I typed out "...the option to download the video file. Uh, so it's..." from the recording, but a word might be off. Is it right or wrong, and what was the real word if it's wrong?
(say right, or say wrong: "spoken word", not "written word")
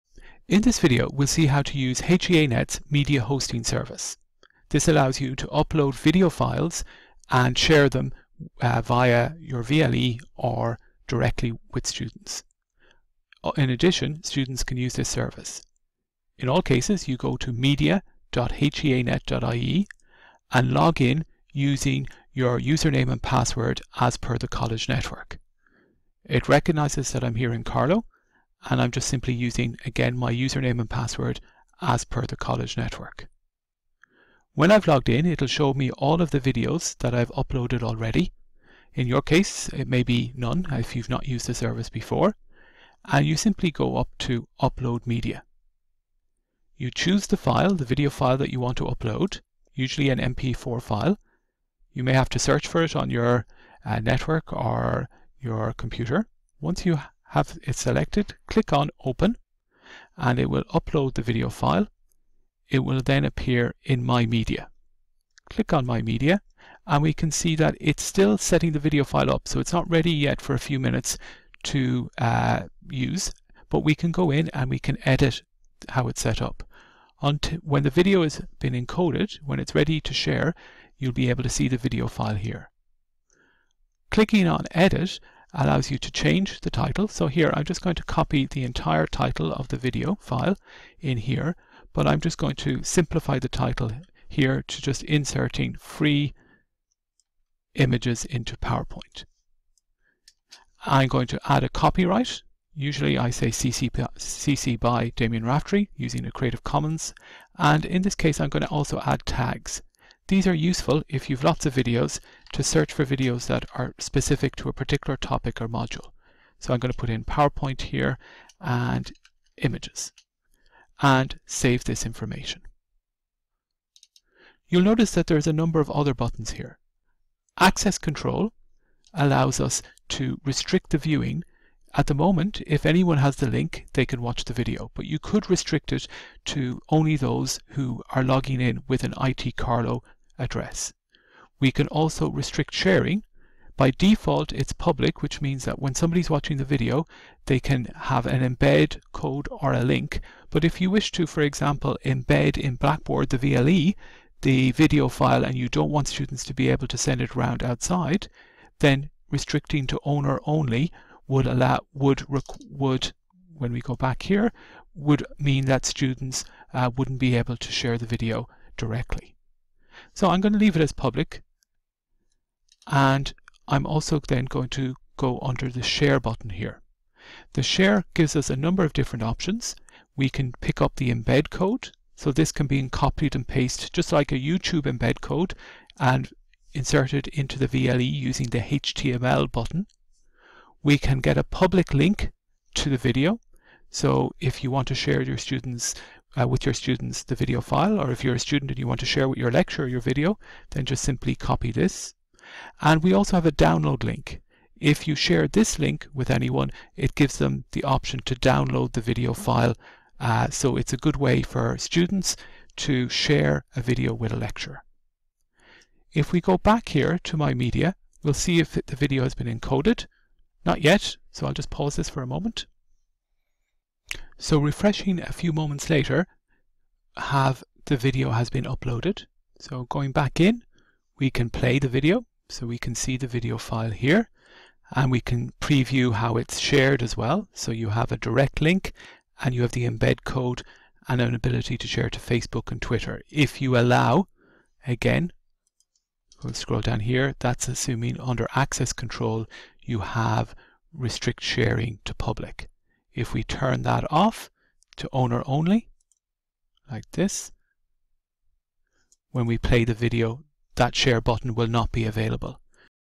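right.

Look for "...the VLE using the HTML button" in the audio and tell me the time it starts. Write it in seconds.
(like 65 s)
187 s.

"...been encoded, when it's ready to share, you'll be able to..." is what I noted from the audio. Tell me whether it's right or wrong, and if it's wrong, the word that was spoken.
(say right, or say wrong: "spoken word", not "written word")
right.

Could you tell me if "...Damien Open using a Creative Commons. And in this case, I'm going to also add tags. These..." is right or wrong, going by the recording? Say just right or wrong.
wrong.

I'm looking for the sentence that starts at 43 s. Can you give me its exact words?
And you simply go up to Upload Media.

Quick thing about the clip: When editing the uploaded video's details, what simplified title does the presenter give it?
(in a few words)
Inserting free images into PowerPoint.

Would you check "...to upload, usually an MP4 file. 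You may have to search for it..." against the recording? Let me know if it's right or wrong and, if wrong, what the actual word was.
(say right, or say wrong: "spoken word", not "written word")
right.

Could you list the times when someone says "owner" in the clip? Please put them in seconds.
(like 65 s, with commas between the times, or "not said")
160 s, 255 s.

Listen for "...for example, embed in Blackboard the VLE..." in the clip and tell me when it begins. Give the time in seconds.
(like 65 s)
151 s.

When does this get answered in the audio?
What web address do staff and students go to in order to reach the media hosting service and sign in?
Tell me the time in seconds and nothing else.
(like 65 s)
17 s.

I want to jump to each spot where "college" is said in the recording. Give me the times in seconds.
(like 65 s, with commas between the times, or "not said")
24 s, 32 s.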